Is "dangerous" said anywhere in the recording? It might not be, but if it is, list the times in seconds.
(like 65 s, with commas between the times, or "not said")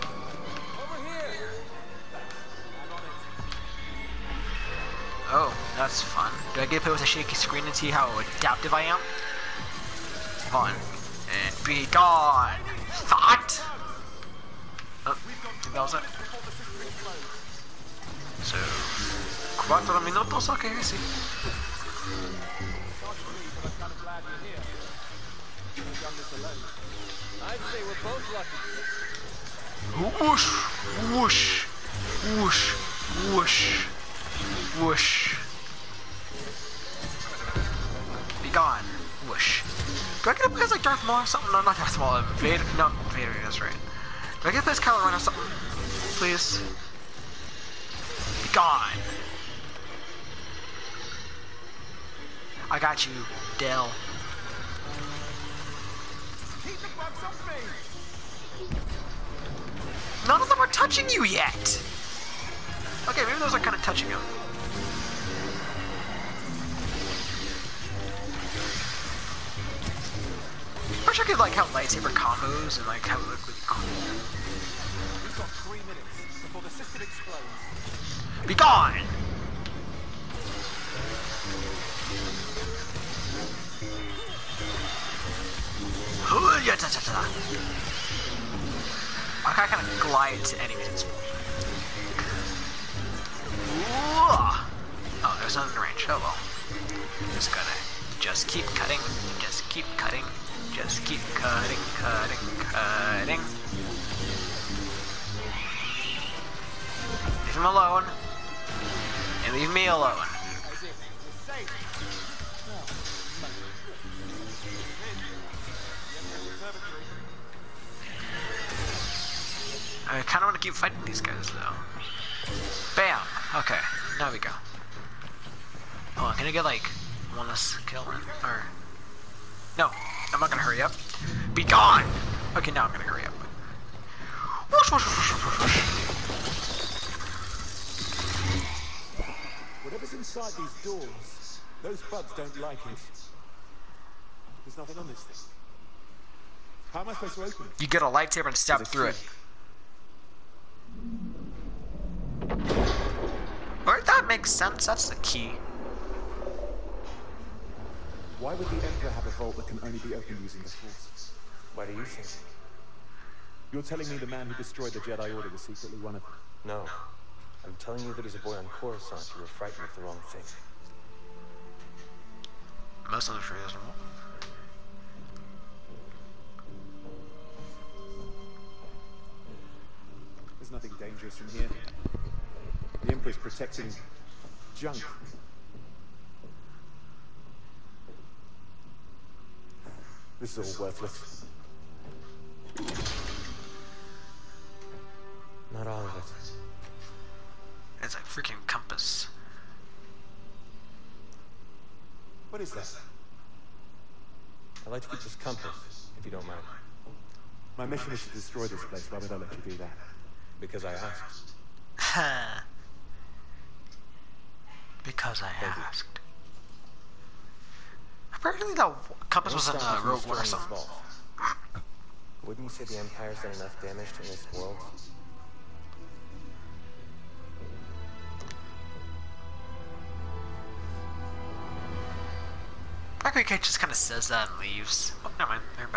180 s.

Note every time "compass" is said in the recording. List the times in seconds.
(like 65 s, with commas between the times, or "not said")
198 s, 205 s, 219 s.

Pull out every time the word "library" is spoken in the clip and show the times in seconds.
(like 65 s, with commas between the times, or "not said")
not said.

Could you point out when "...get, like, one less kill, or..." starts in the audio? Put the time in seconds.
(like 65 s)
126 s.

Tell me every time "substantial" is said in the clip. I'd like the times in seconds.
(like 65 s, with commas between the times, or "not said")
not said.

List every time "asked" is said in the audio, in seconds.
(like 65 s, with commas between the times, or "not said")
210 s, 215 s.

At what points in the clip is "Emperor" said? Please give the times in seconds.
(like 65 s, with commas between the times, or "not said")
158 s, 183 s.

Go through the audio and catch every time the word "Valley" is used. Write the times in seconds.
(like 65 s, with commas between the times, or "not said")
not said.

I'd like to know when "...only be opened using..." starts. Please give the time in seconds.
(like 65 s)
159 s.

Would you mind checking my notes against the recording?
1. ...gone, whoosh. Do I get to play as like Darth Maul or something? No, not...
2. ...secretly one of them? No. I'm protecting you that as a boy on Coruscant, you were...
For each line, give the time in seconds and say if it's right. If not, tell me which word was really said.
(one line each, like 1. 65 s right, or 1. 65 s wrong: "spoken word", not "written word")
1. 38 s right
2. 165 s wrong: "telling", not "protecting".